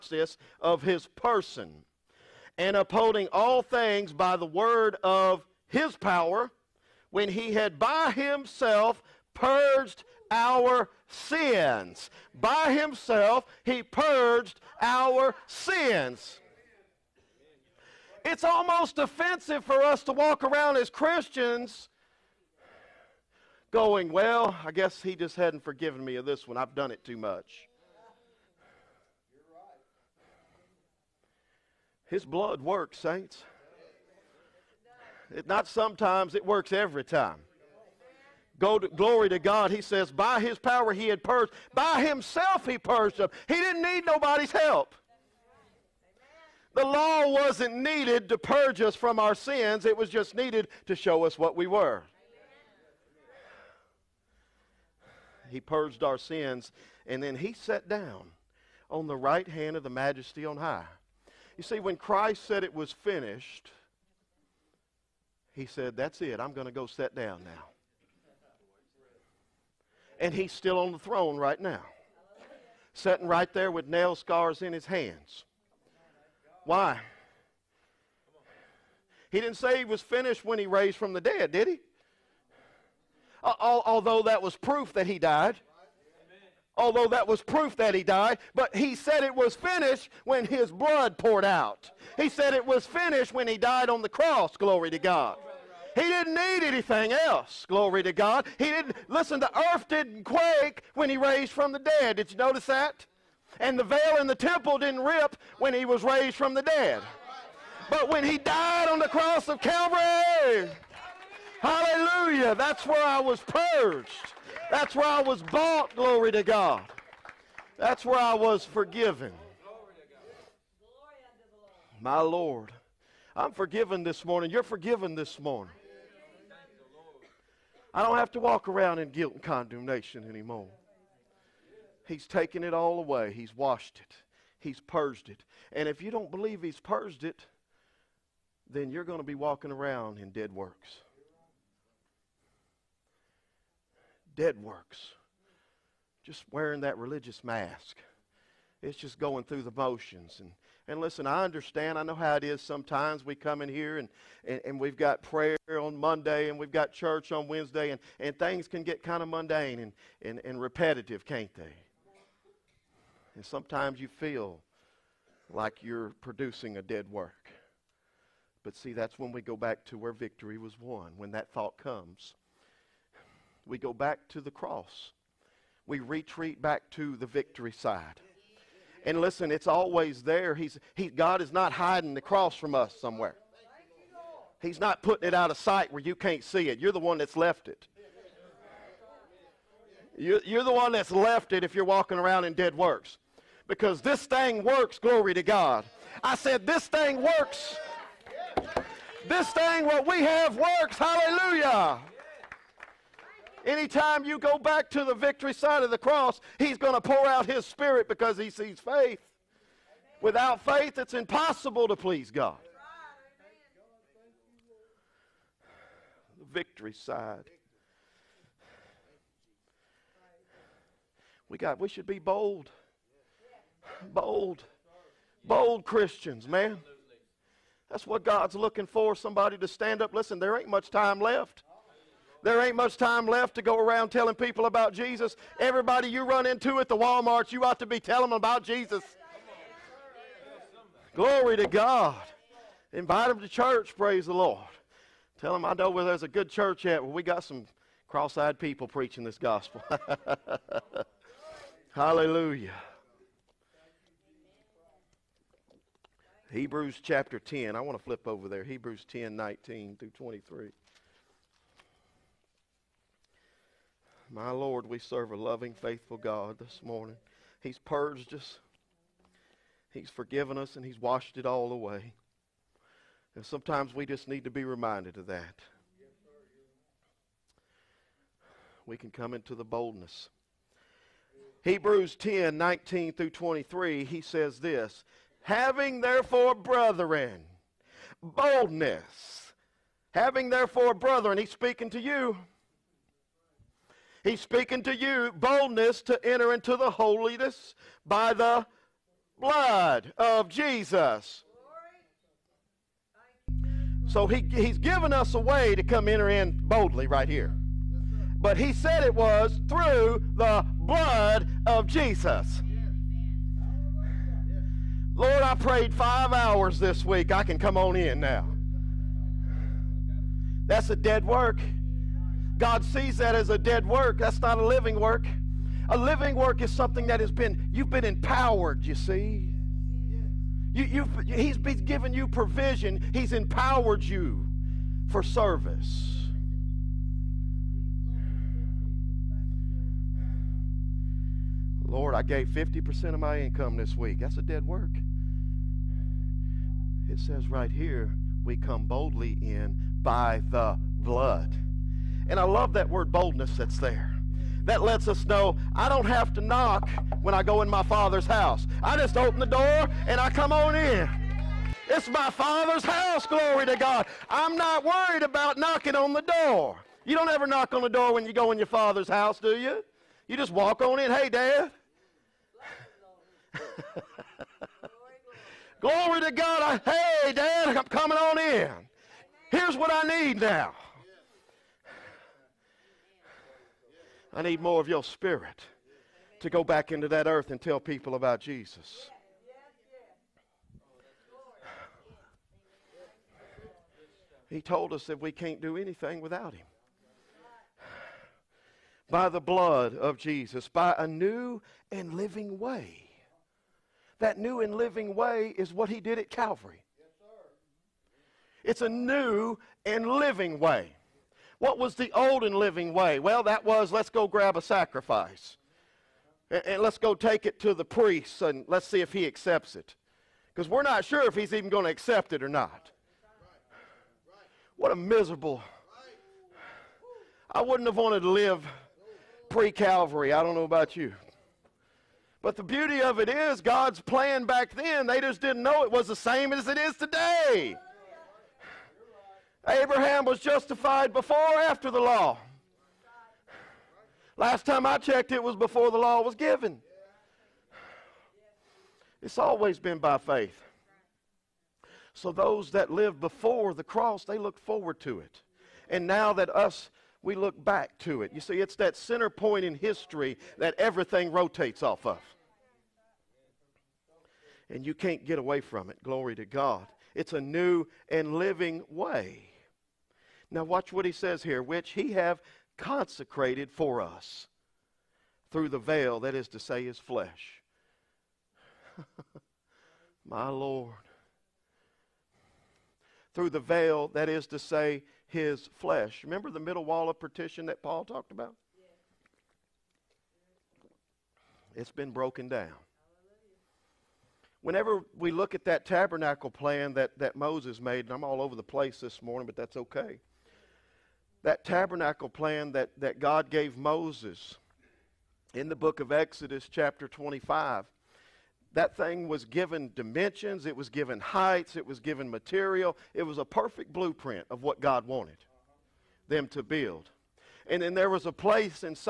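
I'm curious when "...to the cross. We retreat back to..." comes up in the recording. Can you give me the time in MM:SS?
02:54.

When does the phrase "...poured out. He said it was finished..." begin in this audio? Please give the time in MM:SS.
01:31.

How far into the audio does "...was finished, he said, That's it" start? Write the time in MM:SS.
01:02.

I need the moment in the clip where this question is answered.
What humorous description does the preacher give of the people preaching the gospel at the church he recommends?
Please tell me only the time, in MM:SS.
04:08.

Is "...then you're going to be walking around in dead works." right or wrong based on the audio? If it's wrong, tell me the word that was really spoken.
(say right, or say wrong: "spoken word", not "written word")
right.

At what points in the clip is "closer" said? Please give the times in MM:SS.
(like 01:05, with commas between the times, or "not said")
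not said.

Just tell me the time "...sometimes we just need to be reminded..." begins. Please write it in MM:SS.
04:33.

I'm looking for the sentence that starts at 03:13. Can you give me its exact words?
Because this thing works, glory to God.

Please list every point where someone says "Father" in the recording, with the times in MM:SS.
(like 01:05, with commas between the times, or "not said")
05:57, 06:02, 06:08.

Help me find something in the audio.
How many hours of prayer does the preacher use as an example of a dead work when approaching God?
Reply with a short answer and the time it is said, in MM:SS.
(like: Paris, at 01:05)
5, at 05:15.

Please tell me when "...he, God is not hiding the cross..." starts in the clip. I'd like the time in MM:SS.
03:00.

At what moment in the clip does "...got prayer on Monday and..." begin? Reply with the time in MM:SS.
02:34.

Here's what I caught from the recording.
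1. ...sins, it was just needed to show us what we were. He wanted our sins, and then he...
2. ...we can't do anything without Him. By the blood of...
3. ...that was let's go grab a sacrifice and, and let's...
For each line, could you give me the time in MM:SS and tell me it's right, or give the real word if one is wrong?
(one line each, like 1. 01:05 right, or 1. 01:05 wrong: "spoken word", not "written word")
1. 00:49 wrong: "purged", not "wanted"
2. 06:35 right
3. 06:53 right.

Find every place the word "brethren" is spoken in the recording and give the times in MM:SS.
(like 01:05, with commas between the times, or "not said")
04:46, 04:50.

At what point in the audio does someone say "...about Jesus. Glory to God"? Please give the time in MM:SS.
03:58.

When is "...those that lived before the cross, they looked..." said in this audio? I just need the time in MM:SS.
07:32.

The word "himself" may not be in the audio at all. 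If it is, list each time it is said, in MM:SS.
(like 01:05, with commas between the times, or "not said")
00:08, 00:12, 00:42.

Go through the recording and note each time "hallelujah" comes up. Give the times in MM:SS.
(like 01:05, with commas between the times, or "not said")
01:51, 03:20, 04:11.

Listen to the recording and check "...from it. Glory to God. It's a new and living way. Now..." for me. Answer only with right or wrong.
right.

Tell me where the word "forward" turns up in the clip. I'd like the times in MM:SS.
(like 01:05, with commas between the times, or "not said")
07:34.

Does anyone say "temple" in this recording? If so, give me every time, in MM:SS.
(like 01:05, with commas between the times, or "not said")
01:44.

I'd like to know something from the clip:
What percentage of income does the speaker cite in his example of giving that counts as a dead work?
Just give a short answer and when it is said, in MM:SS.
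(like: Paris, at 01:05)
50%, at 05:42.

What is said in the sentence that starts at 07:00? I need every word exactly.
Because we're not sure if he's even going to accept it or not.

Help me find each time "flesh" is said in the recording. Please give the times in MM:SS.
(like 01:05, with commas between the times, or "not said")
07:56, 08:05.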